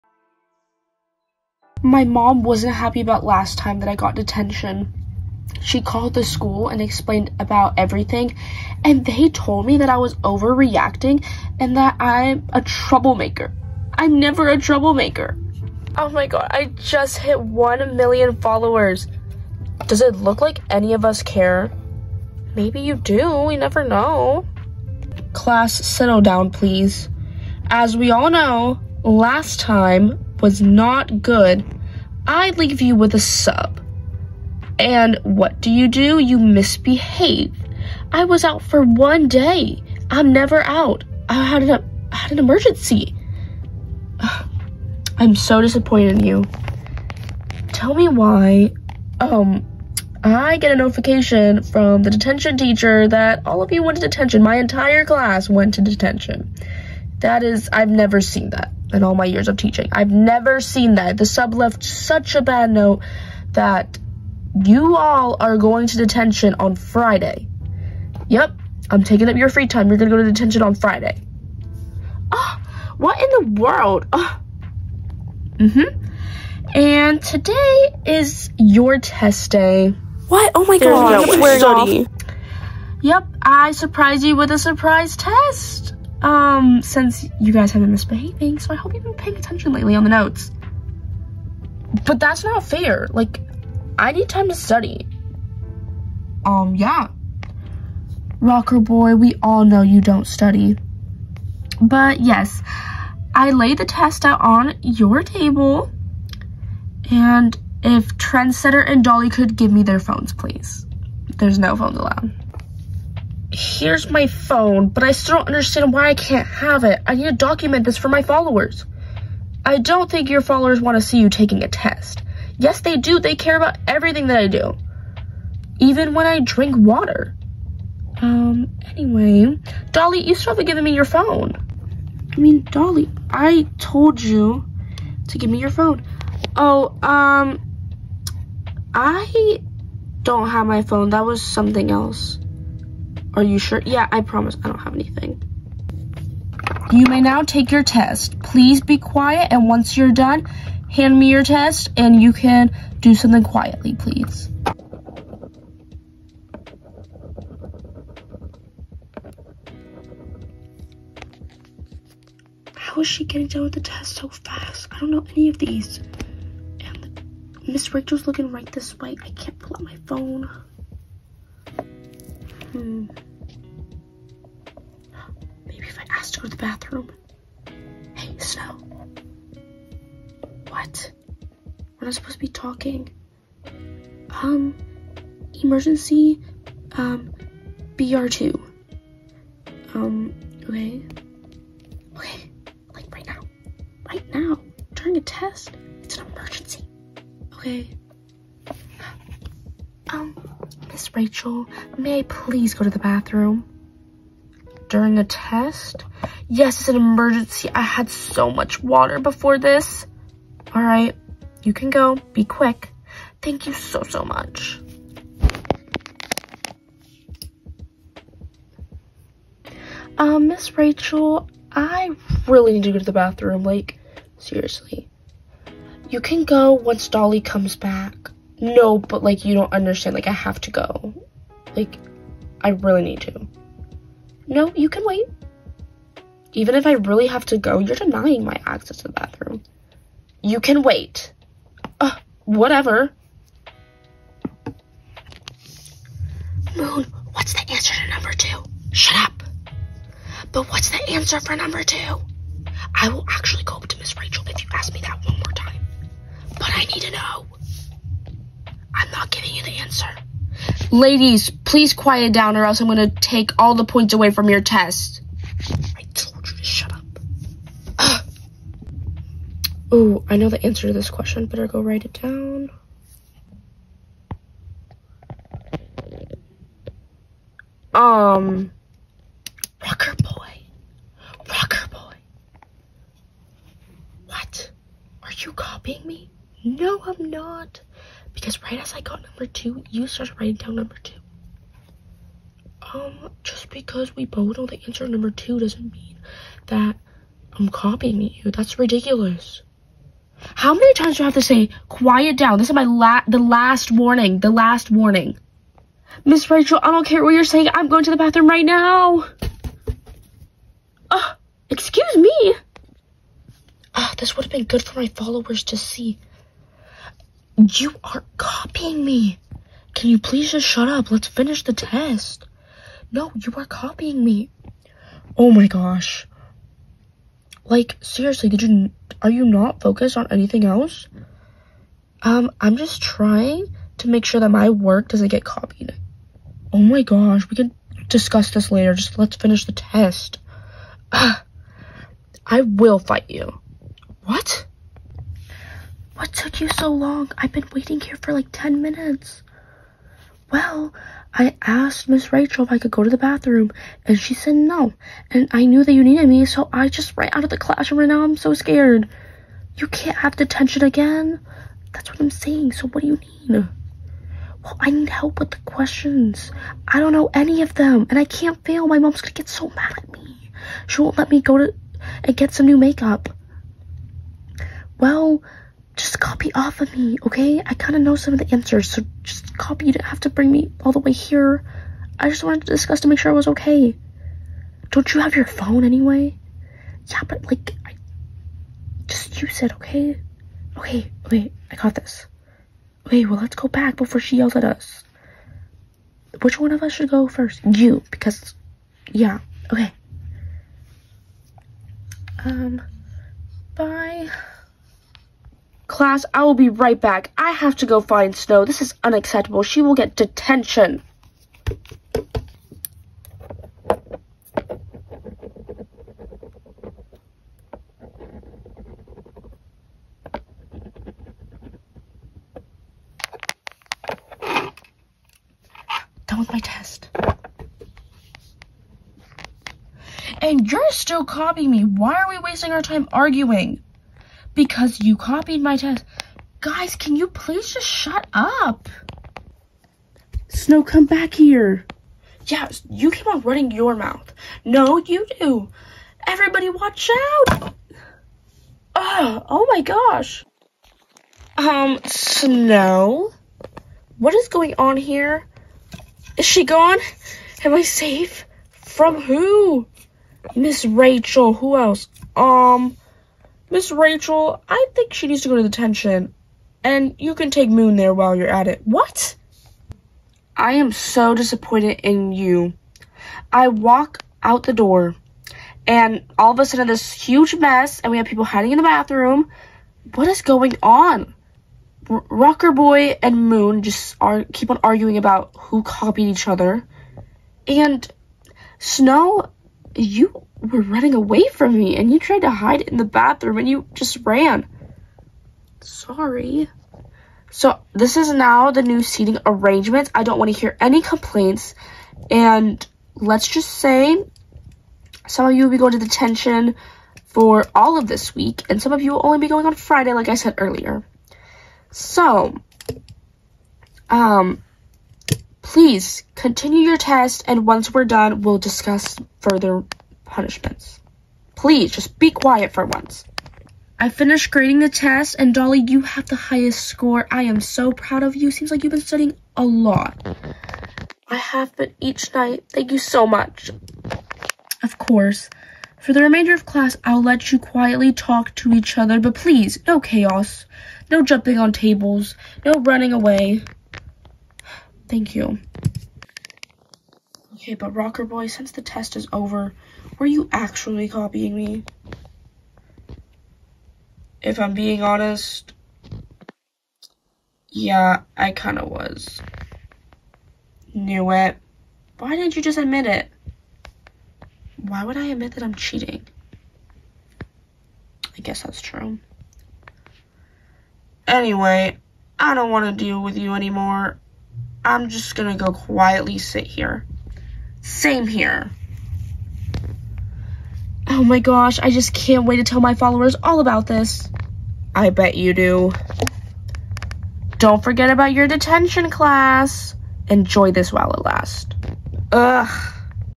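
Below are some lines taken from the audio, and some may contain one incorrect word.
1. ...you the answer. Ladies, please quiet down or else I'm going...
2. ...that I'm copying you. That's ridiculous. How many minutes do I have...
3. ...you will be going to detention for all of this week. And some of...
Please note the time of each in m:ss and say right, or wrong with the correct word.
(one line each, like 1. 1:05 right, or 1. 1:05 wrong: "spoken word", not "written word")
1. 4:19 right
2. 4:56 wrong: "times", not "minutes"
3. 8:25 right.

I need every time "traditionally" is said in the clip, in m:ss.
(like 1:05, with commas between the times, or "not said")
not said.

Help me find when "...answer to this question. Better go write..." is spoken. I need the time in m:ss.
4:30.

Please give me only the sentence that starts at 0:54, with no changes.
My entire class went to detention.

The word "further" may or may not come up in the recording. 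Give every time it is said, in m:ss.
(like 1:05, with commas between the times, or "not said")
8:39.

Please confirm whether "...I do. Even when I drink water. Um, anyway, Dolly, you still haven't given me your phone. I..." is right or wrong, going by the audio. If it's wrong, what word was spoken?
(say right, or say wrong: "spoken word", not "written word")
right.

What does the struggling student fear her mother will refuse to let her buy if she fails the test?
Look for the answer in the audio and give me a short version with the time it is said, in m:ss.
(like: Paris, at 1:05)
new makeup, at 6:12.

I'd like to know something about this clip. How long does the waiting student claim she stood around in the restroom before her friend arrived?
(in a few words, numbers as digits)
10 minutes.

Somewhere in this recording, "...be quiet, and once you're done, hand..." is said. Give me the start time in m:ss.
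2:28.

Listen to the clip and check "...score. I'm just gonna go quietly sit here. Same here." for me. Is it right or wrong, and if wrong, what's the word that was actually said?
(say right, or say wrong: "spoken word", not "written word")
wrong: "anymore", not "score".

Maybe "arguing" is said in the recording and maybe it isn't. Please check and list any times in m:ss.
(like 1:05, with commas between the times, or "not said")
7:13, 8:04.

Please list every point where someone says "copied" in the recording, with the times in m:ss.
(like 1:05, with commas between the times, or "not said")
5:35, 7:15, 8:05.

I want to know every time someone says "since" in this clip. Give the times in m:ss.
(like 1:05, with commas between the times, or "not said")
1:26, 9:08.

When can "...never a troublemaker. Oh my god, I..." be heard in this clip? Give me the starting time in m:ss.
0:14.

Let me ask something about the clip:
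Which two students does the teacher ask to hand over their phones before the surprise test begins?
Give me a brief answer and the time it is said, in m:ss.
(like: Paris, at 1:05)
Trendsetter and Dolly, at 1:48.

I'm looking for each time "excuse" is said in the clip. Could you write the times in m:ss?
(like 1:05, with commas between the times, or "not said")
5:11.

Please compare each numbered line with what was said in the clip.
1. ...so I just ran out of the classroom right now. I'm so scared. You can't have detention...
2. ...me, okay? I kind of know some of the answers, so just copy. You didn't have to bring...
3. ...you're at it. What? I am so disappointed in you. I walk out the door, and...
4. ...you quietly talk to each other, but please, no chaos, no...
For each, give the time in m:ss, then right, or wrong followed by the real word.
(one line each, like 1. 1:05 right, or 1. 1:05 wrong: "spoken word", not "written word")
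1. 5:56 right
2. 6:16 right
3. 7:48 right
4. 8:57 right.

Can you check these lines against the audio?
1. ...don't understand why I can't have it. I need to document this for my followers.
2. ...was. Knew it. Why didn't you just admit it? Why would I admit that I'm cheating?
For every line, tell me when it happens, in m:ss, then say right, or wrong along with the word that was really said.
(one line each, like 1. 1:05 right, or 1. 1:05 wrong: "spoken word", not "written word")
1. 1:55 right
2. 9:18 right.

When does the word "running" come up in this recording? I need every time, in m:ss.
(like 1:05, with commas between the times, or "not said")
7:23, 8:10, 9:02.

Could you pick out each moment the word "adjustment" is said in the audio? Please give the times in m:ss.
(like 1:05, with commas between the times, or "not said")
not said.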